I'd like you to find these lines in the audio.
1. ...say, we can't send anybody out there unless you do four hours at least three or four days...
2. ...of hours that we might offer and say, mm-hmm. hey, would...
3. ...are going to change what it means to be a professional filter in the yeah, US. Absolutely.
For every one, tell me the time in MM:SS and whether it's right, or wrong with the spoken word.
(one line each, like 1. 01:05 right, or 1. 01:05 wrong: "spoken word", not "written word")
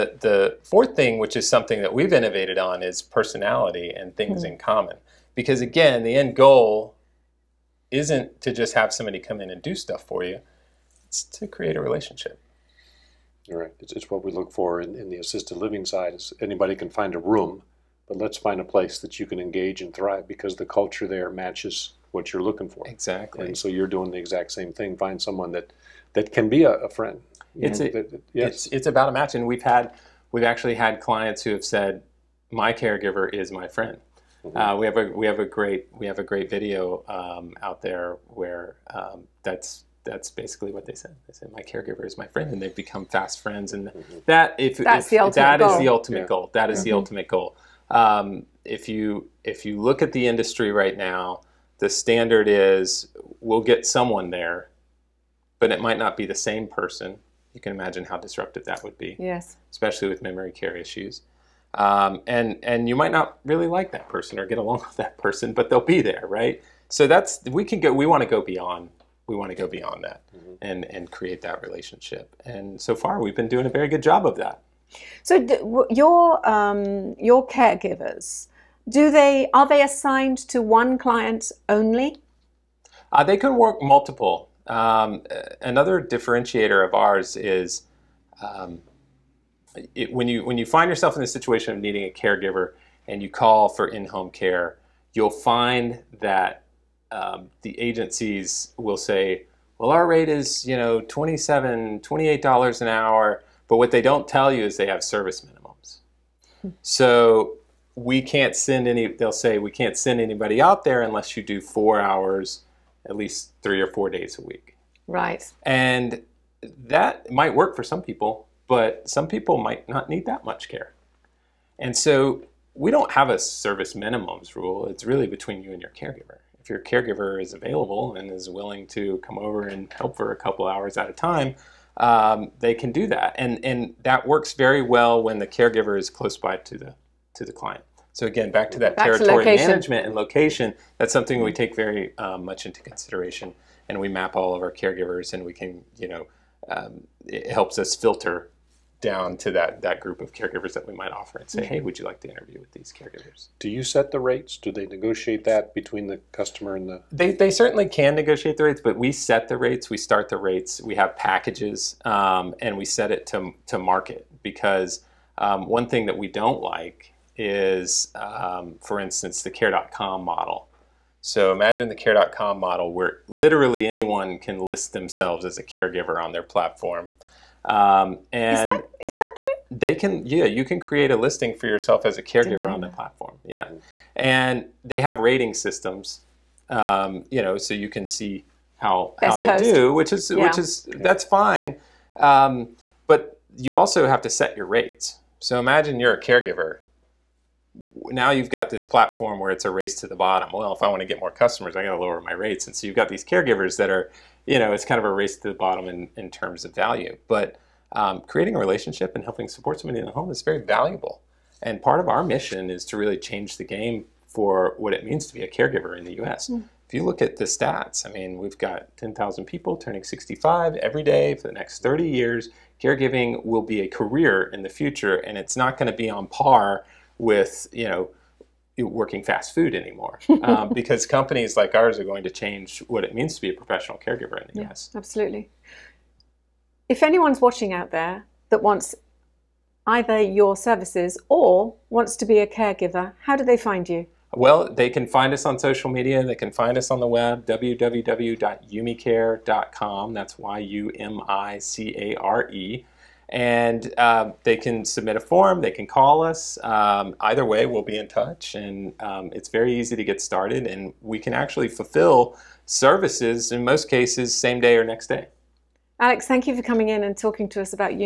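1. 01:49 right
2. 02:30 wrong: "caregivers", not "hours"
3. 03:51 wrong: "caregiver", not "filter".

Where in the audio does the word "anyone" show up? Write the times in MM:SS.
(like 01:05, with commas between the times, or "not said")
02:53, 03:57.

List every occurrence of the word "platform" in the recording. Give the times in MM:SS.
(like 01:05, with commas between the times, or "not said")
02:56, 03:02, 03:18.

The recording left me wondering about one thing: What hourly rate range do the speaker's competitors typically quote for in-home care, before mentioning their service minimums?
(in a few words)
$27-28.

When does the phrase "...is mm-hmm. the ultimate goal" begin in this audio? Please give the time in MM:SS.
00:46.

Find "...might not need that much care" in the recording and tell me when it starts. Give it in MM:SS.
01:59.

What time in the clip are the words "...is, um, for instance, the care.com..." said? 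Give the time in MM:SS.
02:47.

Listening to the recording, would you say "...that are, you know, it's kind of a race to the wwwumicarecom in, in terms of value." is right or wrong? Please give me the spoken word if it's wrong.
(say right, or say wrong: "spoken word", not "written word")
wrong: "bottom", not "wwwumicarecom".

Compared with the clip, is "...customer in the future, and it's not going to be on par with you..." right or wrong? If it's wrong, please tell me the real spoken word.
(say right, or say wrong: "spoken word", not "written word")
wrong: "career", not "customer".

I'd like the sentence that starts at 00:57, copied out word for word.
You can imagine how disruptive that would be.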